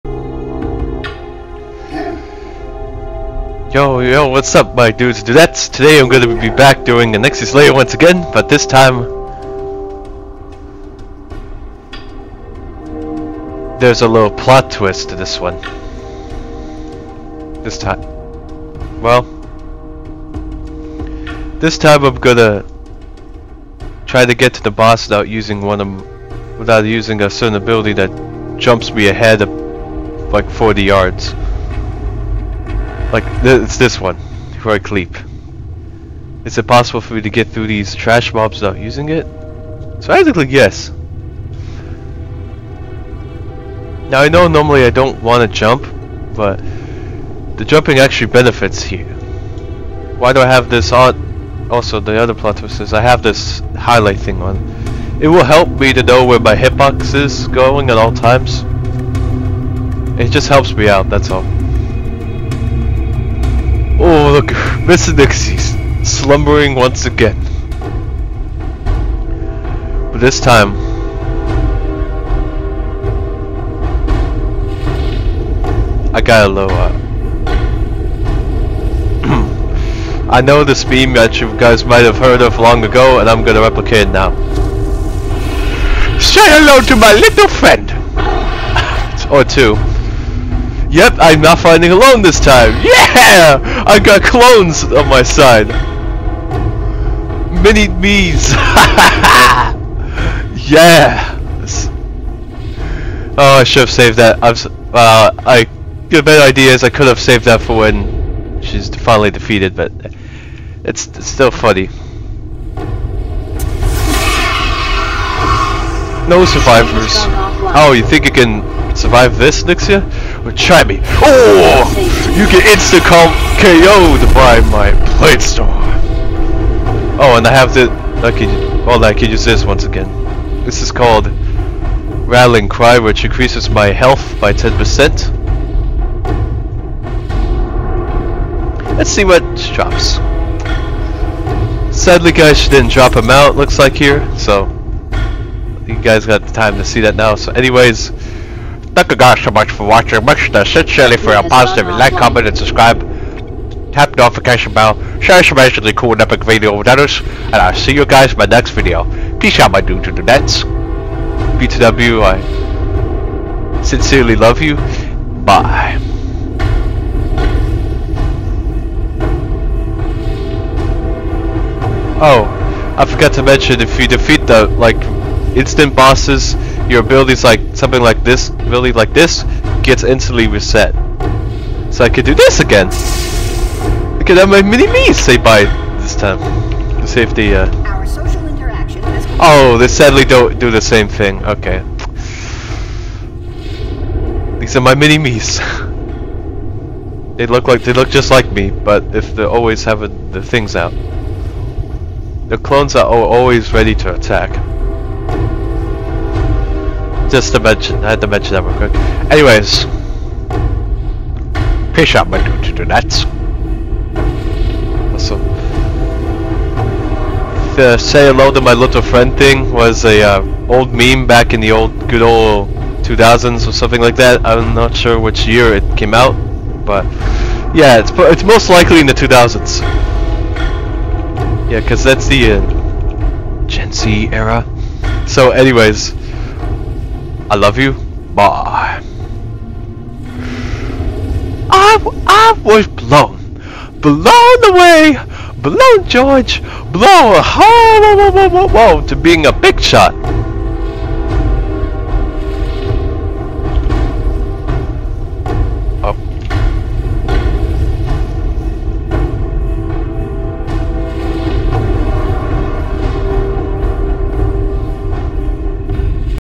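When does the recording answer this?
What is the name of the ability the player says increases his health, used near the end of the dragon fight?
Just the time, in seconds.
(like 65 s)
132 s.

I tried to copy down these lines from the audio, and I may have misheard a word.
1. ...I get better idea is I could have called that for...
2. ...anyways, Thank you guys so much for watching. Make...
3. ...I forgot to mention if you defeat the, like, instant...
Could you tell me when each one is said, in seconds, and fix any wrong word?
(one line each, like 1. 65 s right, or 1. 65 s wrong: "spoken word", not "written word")
1. 105 s wrong: "saved", not "called"
2. 147 s right
3. 172 s right.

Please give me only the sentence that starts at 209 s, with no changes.
Anyways, fish out my dude to do that.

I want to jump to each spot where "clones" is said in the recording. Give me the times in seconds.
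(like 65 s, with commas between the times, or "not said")
94 s, 202 s.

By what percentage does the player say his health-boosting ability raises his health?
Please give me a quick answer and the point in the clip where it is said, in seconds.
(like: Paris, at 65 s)
10%, at 134 s.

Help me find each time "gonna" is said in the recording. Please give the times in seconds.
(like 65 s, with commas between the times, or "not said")
22 s, 83 s.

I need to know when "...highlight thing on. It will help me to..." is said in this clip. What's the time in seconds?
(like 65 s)
53 s.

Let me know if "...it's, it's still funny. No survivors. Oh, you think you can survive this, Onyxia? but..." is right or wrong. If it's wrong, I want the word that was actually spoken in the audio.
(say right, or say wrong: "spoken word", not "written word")
right.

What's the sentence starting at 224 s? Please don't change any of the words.
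I'm not sure which year it came out, but yeah, it's it's most likely in the 2000s.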